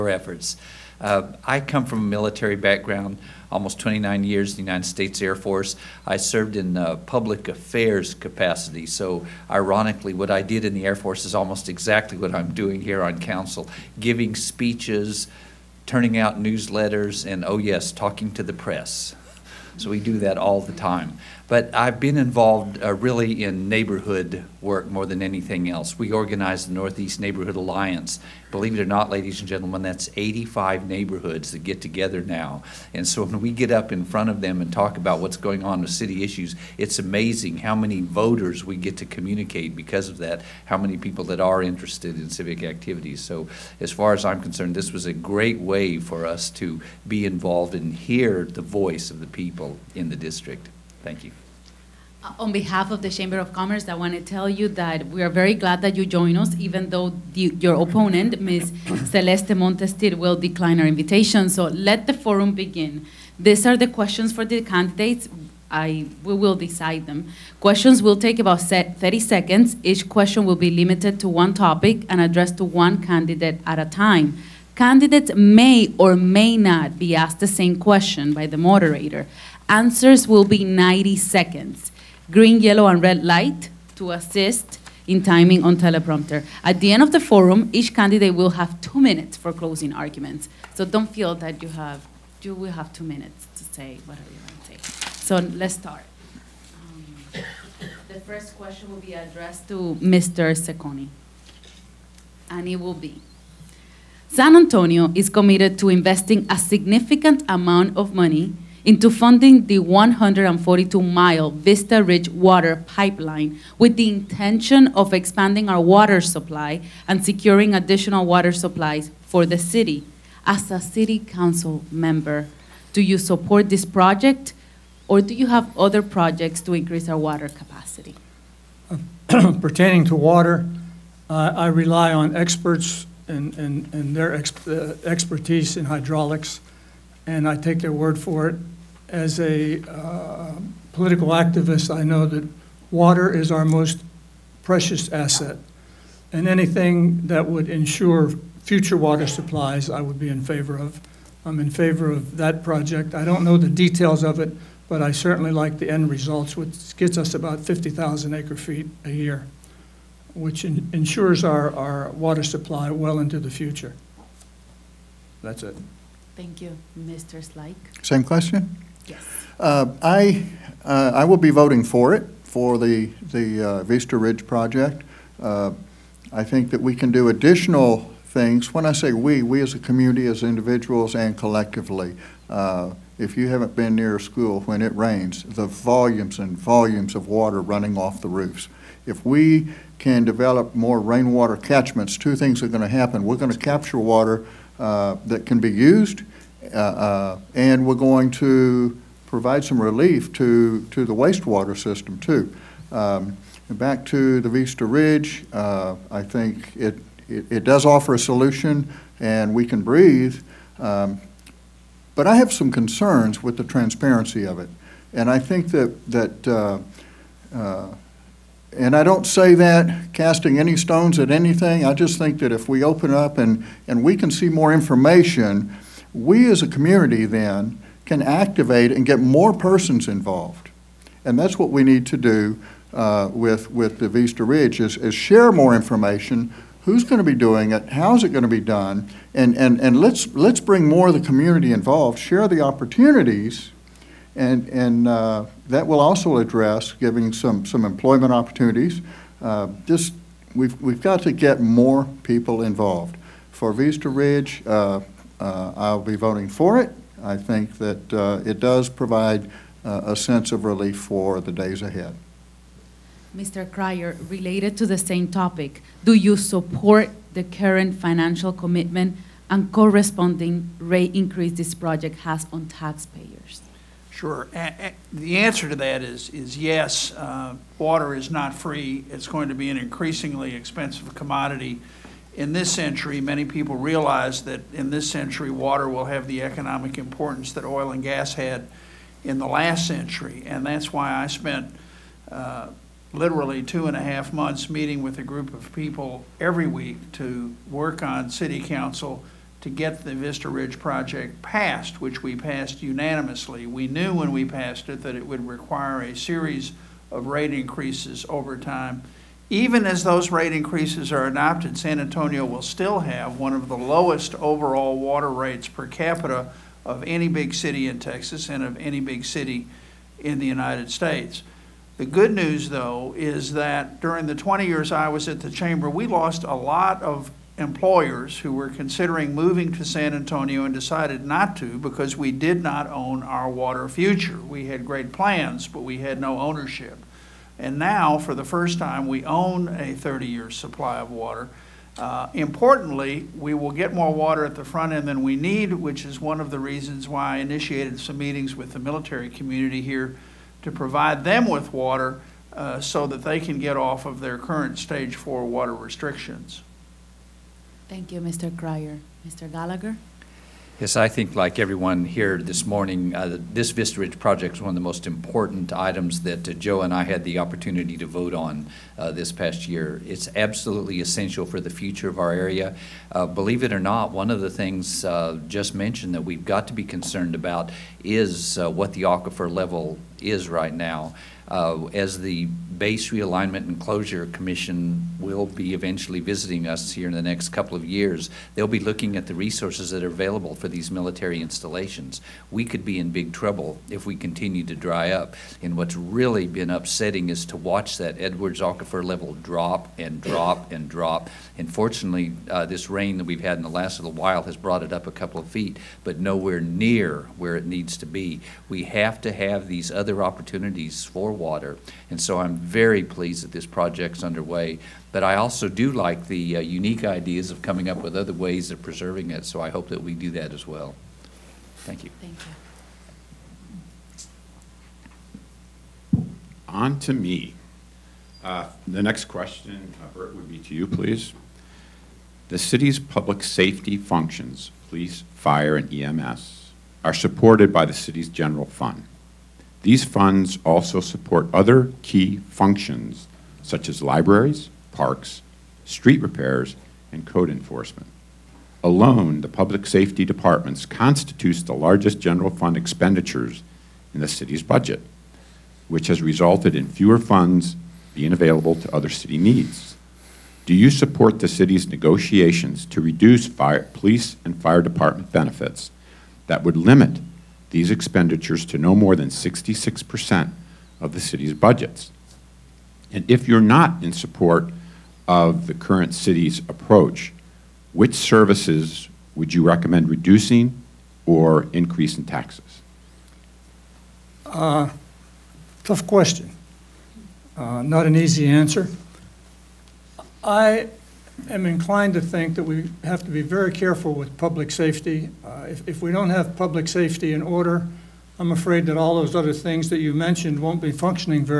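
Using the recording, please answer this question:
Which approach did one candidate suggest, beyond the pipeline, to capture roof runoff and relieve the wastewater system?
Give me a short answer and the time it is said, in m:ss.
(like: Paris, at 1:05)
rainwater catchments, at 3:10.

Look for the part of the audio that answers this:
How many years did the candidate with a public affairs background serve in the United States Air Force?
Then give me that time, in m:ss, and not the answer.
0:03.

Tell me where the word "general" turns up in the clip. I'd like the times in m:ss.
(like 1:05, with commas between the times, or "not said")
7:18, 7:32.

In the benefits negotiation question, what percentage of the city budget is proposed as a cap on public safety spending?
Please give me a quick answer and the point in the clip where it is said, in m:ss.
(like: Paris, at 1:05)
66%, at 7:49.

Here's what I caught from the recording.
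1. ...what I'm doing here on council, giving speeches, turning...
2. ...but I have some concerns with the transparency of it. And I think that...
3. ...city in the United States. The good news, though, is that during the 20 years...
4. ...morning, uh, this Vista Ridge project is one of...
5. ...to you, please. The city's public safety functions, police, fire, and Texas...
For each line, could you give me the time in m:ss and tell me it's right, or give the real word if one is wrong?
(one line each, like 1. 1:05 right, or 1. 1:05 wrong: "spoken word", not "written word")
1. 0:12 right
2. 3:32 right
3. 5:19 right
4. 6:02 right
5. 7:10 wrong: "EMS", not "Texas".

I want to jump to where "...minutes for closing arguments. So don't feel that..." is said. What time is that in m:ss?
1:29.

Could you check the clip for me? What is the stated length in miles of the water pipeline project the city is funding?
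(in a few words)
142 miles.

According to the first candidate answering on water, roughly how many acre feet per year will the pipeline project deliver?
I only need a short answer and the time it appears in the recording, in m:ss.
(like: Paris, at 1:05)
50,000, at 2:37.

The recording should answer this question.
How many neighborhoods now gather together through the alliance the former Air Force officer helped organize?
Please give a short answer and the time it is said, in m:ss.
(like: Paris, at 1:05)
85, at 0:30.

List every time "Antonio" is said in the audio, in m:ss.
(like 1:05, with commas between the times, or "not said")
1:44, 5:11, 5:30.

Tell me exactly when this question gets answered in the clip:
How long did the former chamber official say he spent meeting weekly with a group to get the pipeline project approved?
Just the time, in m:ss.
4:53.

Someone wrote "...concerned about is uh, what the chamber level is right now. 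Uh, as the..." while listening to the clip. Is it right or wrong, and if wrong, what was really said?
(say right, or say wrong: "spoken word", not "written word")
wrong: "aquifer", not "chamber".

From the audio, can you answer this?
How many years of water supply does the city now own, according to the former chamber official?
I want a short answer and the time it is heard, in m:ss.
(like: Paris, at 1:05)
30 years, at 5:39.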